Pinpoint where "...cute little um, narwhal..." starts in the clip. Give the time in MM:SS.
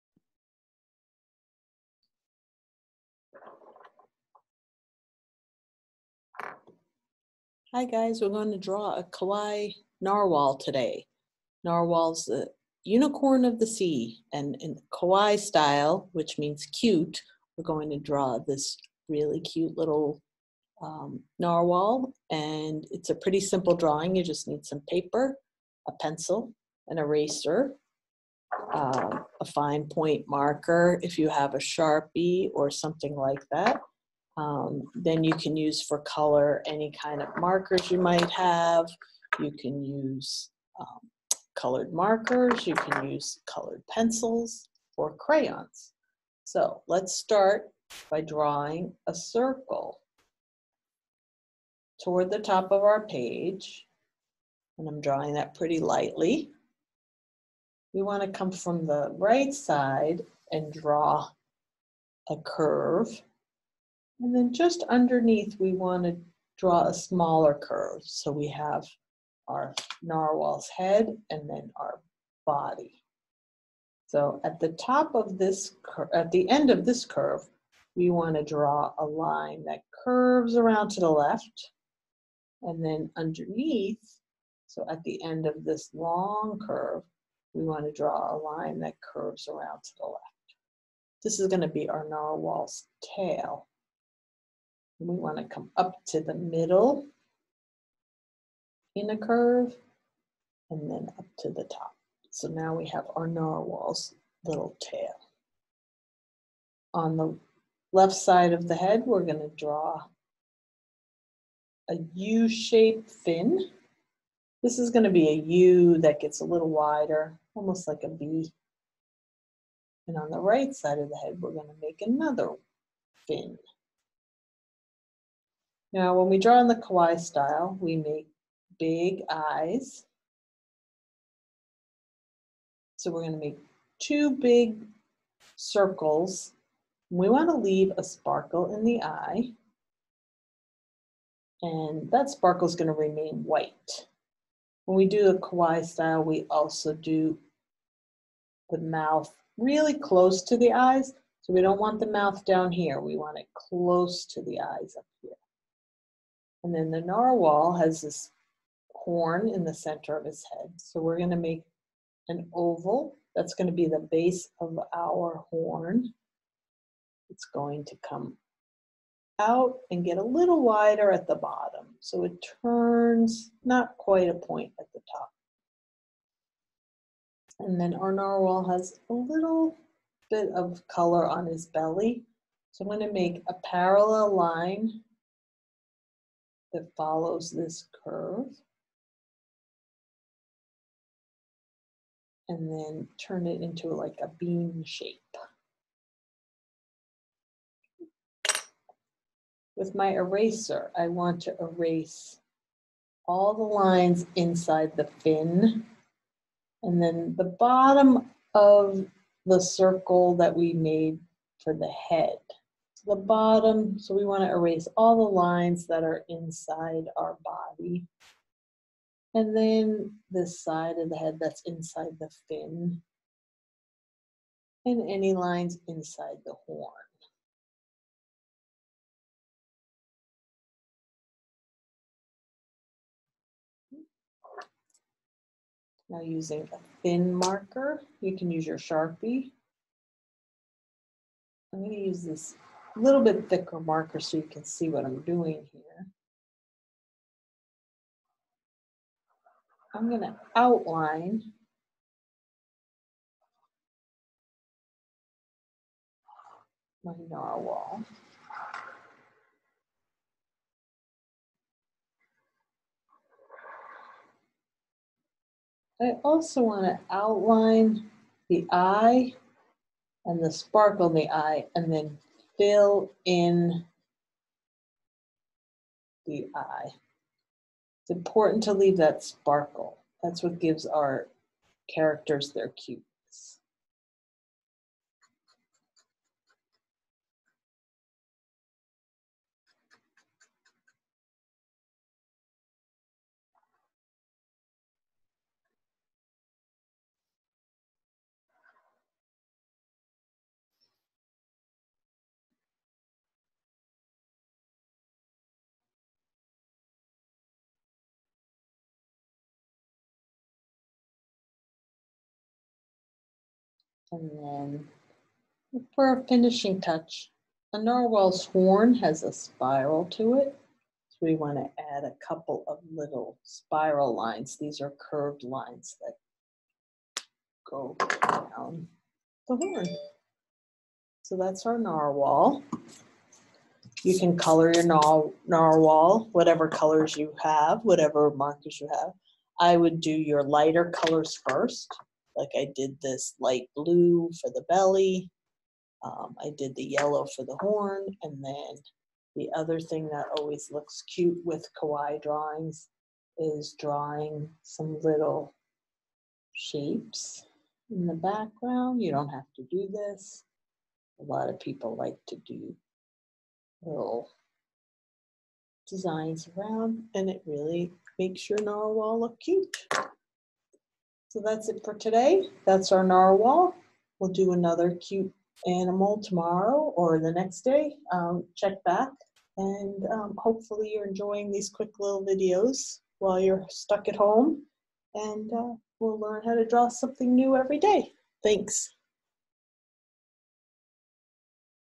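00:19.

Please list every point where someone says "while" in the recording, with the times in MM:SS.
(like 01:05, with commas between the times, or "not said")
06:23.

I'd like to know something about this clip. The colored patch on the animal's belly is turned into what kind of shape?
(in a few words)
bean shape.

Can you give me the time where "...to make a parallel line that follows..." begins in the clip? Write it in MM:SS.
03:03.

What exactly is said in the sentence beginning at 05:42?
Like I did this light blue for the belly.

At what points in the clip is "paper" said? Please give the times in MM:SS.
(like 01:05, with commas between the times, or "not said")
00:24.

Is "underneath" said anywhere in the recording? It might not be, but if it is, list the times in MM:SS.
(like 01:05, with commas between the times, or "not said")
01:04, 01:23.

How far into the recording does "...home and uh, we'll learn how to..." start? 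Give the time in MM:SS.
06:24.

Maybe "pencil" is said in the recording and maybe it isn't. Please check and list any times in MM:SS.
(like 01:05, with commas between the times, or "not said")
00:26, 00:43.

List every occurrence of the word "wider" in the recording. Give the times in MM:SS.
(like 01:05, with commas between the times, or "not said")
01:56, 02:50.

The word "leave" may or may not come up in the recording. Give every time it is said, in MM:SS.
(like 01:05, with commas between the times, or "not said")
02:17, 04:38.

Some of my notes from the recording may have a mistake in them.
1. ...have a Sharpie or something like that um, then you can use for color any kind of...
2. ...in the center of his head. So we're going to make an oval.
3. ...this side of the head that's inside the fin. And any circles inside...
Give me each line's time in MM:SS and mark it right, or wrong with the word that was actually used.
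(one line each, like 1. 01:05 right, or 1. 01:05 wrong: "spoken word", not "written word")
1. 00:31 right
2. 02:39 right
3. 03:40 wrong: "lines", not "circles".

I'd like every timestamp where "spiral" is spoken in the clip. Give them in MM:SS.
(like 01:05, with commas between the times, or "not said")
05:19, 05:23.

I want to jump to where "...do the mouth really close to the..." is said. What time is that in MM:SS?
02:26.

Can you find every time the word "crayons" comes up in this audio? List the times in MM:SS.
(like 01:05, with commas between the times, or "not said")
00:45.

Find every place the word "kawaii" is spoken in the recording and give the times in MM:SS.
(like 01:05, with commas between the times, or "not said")
00:09, 00:14, 02:06, 02:25, 05:51.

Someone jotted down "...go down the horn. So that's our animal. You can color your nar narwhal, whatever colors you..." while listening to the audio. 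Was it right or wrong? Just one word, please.
wrong.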